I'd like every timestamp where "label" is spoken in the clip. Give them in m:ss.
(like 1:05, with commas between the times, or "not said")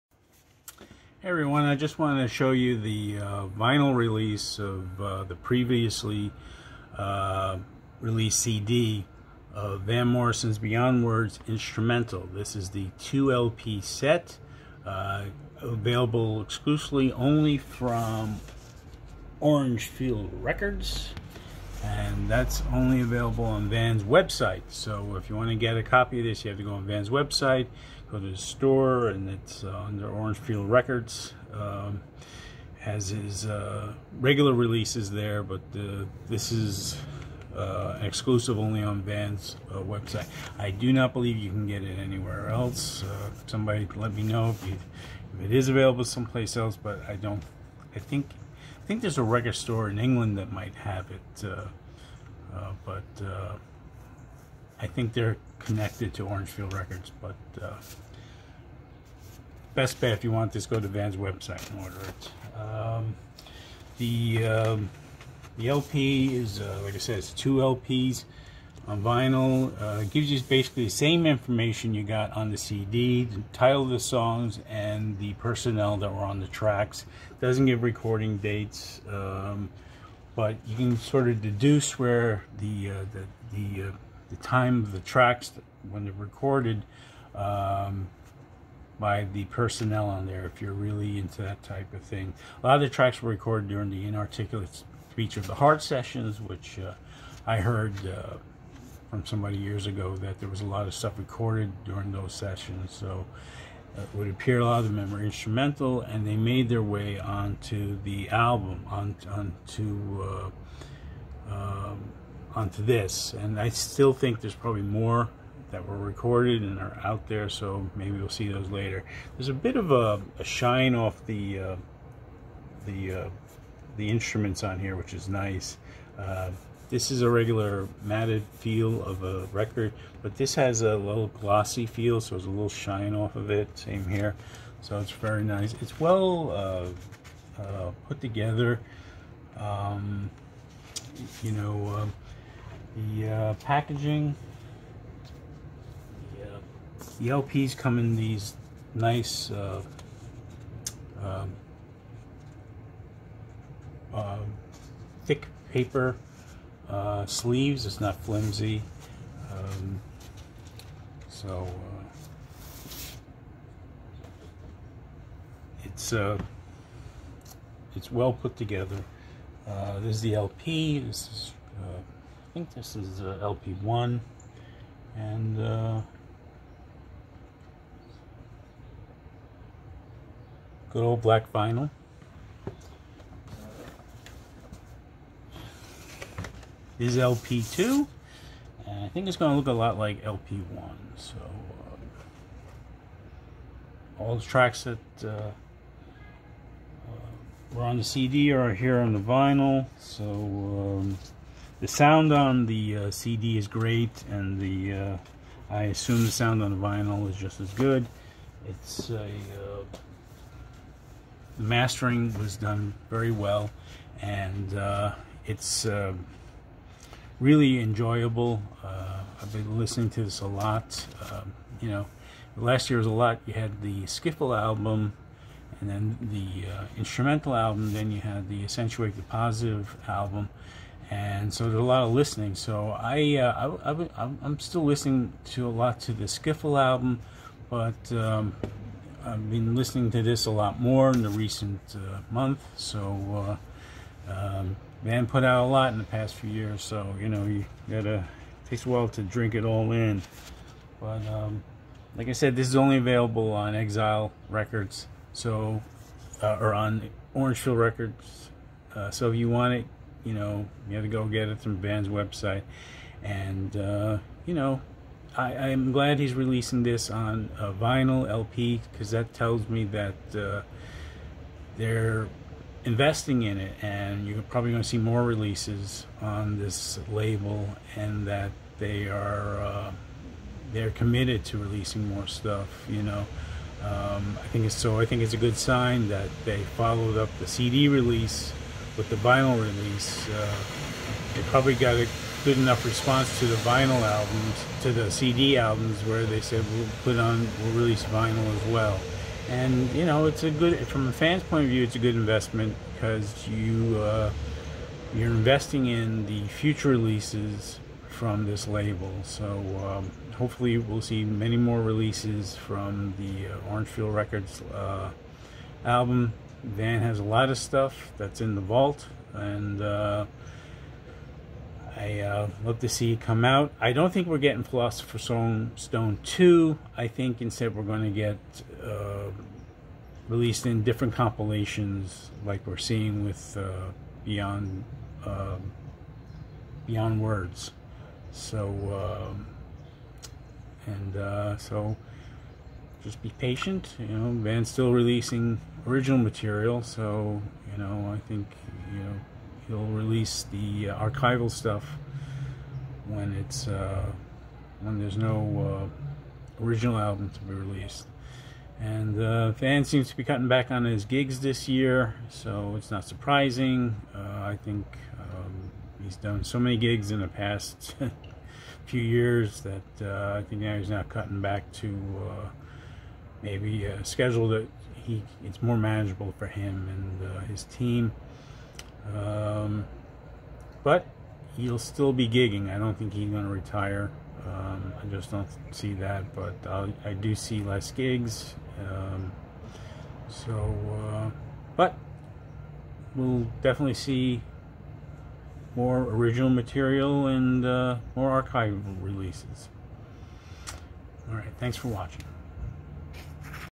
4:37, 5:08.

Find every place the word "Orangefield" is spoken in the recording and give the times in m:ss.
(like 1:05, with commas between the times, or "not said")
0:19, 0:56, 4:17, 5:13.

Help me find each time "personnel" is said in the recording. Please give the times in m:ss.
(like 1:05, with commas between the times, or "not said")
1:15, 1:29.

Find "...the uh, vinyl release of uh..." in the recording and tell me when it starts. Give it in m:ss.
0:02.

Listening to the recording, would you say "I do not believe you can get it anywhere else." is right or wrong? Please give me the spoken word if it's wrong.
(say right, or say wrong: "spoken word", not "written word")
right.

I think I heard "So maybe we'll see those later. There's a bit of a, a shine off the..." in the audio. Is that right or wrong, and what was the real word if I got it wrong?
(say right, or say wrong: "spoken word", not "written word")
right.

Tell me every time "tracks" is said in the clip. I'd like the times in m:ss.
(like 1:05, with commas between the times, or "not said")
1:16, 1:24, 1:32, 3:14.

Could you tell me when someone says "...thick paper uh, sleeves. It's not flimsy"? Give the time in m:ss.
2:35.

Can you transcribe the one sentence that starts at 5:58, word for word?
And uh, Van seems to be cutting back on his gigs this year, so it's not surprising.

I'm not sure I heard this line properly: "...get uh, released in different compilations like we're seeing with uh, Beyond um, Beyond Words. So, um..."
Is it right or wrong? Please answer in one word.
right.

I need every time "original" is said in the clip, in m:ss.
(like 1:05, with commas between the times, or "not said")
5:45, 5:56, 6:35.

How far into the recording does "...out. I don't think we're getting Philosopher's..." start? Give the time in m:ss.
5:23.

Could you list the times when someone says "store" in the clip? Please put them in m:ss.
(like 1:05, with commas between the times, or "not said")
0:28, 0:49.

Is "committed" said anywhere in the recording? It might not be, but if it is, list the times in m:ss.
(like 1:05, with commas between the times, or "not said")
4:40.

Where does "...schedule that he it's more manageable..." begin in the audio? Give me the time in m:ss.
6:14.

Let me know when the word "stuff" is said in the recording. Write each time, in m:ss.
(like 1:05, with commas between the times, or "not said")
1:40, 4:42, 5:17, 5:51.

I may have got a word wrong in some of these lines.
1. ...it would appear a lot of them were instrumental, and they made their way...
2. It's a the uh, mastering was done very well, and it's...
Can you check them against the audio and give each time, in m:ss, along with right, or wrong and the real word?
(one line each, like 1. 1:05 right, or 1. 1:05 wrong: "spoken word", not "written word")
1. 1:44 right
2. 3:28 right.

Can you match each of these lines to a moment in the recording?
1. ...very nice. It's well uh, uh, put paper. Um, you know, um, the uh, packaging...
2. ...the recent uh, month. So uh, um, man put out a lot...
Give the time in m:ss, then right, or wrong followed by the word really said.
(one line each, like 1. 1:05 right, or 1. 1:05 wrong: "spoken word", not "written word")
1. 2:15 wrong: "together", not "paper"
2. 4:01 right.